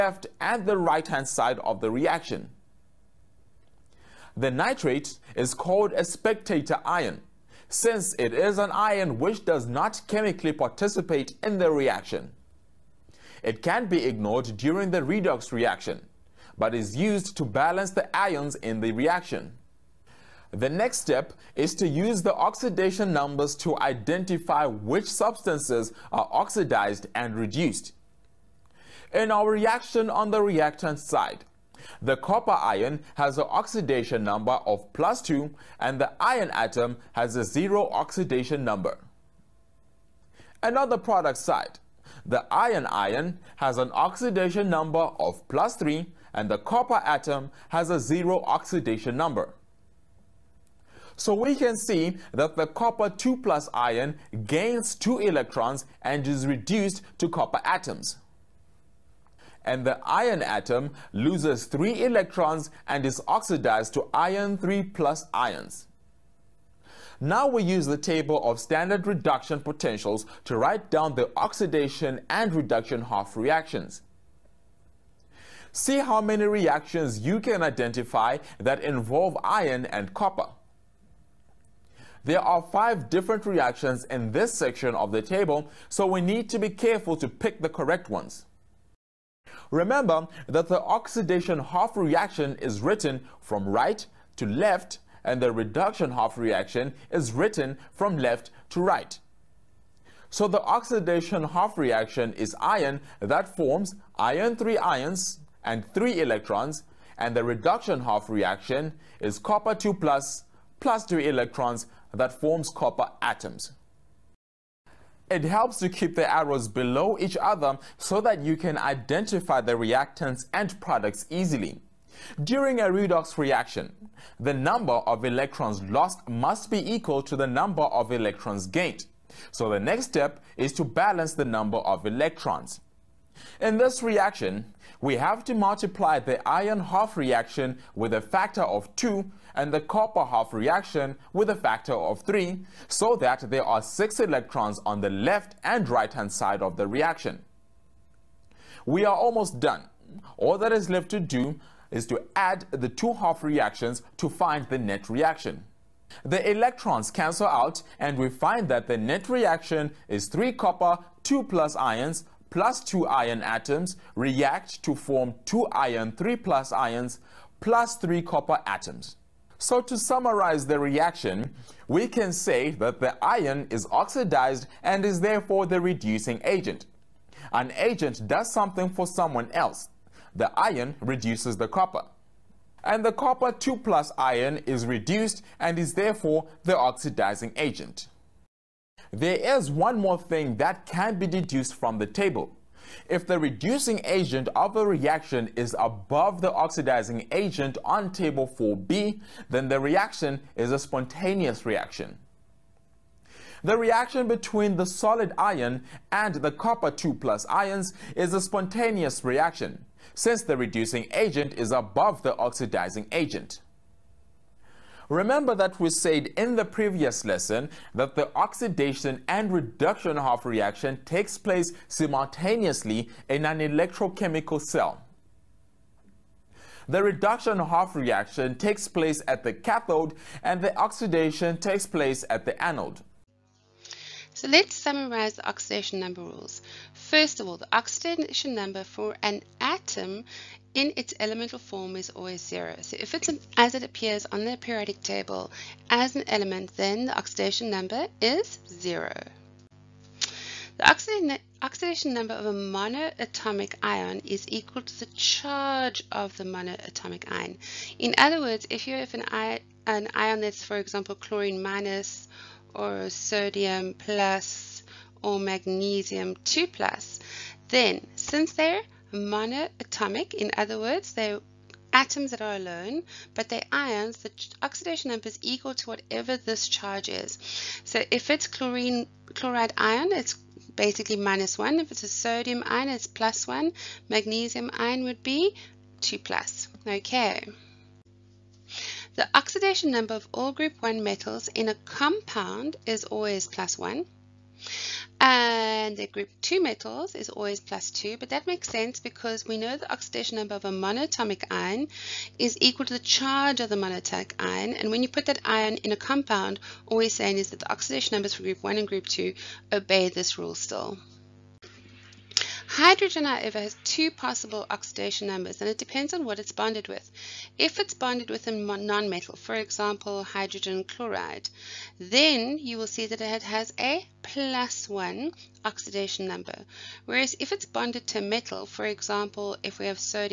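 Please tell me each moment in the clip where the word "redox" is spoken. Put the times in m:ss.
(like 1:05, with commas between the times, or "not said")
0:15, 2:02.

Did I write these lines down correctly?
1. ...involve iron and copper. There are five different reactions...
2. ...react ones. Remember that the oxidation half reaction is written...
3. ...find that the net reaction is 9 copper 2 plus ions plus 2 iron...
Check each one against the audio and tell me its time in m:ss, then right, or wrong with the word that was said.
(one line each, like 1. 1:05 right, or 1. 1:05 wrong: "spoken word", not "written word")
1. 1:18 right
2. 1:27 wrong: "correct", not "react"
3. 2:38 wrong: "3", not "9".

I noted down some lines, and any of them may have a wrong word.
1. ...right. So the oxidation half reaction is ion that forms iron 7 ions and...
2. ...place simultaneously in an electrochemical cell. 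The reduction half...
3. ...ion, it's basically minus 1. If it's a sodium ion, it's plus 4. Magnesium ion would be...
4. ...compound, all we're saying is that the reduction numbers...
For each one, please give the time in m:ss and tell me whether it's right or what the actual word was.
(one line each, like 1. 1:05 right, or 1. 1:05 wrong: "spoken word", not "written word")
1. 1:38 wrong: "3", not "7"
2. 3:41 right
3. 4:39 wrong: "1", not "4"
4. 5:05 wrong: "oxidation", not "reduction".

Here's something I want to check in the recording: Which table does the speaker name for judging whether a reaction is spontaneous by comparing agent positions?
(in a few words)
table 4b.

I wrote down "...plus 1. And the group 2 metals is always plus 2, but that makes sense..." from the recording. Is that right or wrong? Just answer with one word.
right.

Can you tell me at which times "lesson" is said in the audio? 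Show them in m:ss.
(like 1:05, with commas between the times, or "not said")
3:37.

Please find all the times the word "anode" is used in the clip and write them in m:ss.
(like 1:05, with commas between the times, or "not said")
3:52.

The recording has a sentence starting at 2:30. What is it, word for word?
All that is left to do is to add the two half reactions to find the net reaction.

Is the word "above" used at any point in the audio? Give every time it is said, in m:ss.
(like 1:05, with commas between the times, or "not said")
3:15, 3:31.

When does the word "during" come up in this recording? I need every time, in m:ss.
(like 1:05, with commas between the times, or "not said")
0:14, 2:02.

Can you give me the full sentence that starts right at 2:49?
So to summarize the reaction, we can say that the iron is oxidized and is therefore the reducing agent.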